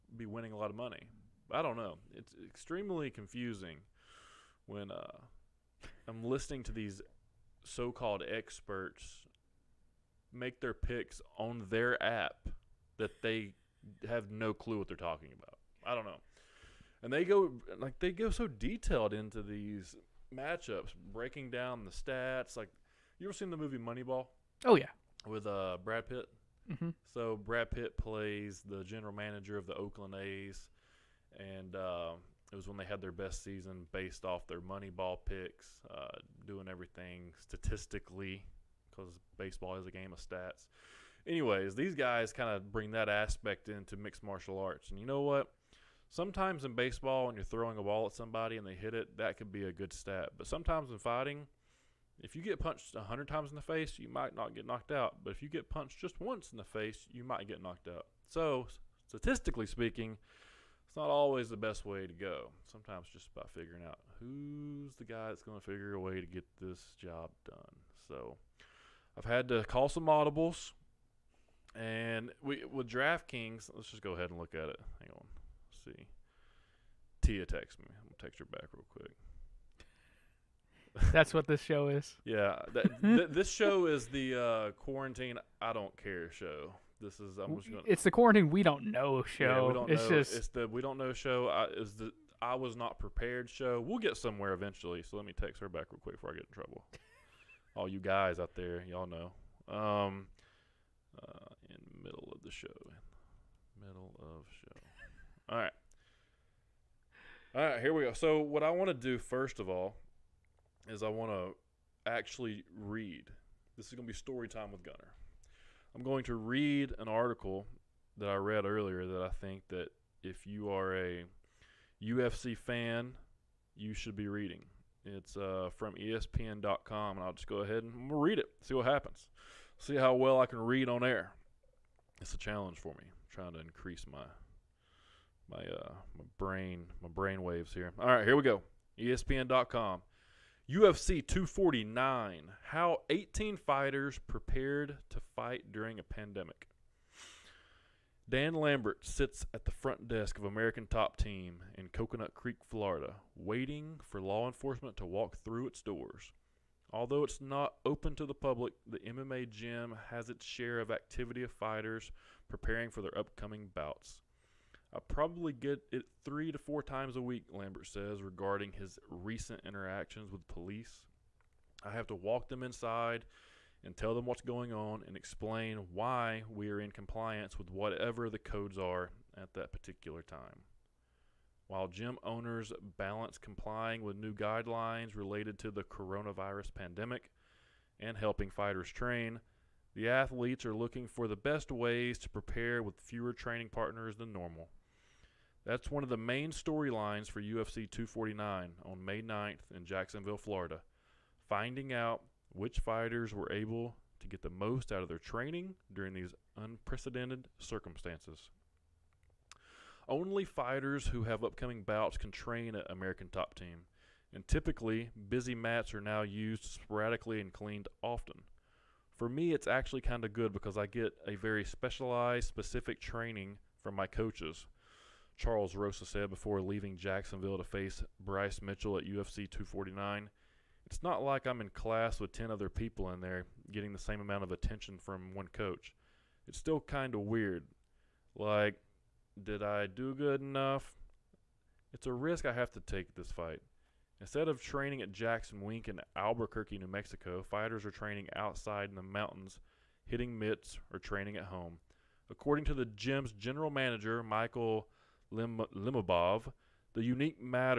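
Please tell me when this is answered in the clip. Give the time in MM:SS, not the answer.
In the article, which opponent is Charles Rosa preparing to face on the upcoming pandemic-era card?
03:48.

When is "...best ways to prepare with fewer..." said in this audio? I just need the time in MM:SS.
03:11.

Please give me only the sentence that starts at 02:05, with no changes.
It's uh, from ESPN.com, and I'll just go ahead and read it.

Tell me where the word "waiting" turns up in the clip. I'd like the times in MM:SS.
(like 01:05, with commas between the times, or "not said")
02:33.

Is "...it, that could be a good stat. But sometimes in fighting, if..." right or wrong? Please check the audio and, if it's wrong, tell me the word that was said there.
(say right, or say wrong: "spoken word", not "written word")
right.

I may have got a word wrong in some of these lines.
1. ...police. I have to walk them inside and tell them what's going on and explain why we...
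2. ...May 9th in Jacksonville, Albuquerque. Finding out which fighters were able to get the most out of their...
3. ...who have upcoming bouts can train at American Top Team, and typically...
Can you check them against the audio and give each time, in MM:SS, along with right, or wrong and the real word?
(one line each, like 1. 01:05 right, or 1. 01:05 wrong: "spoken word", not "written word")
1. 02:50 right
2. 03:19 wrong: "Florida", not "Albuquerque"
3. 03:31 right.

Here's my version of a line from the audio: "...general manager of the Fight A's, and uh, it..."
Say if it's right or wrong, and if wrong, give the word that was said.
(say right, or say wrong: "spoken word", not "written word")
wrong: "Oakland", not "Fight".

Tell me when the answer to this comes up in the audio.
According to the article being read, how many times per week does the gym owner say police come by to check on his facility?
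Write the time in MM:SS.
02:46.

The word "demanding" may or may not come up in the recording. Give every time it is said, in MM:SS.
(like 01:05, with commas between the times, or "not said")
not said.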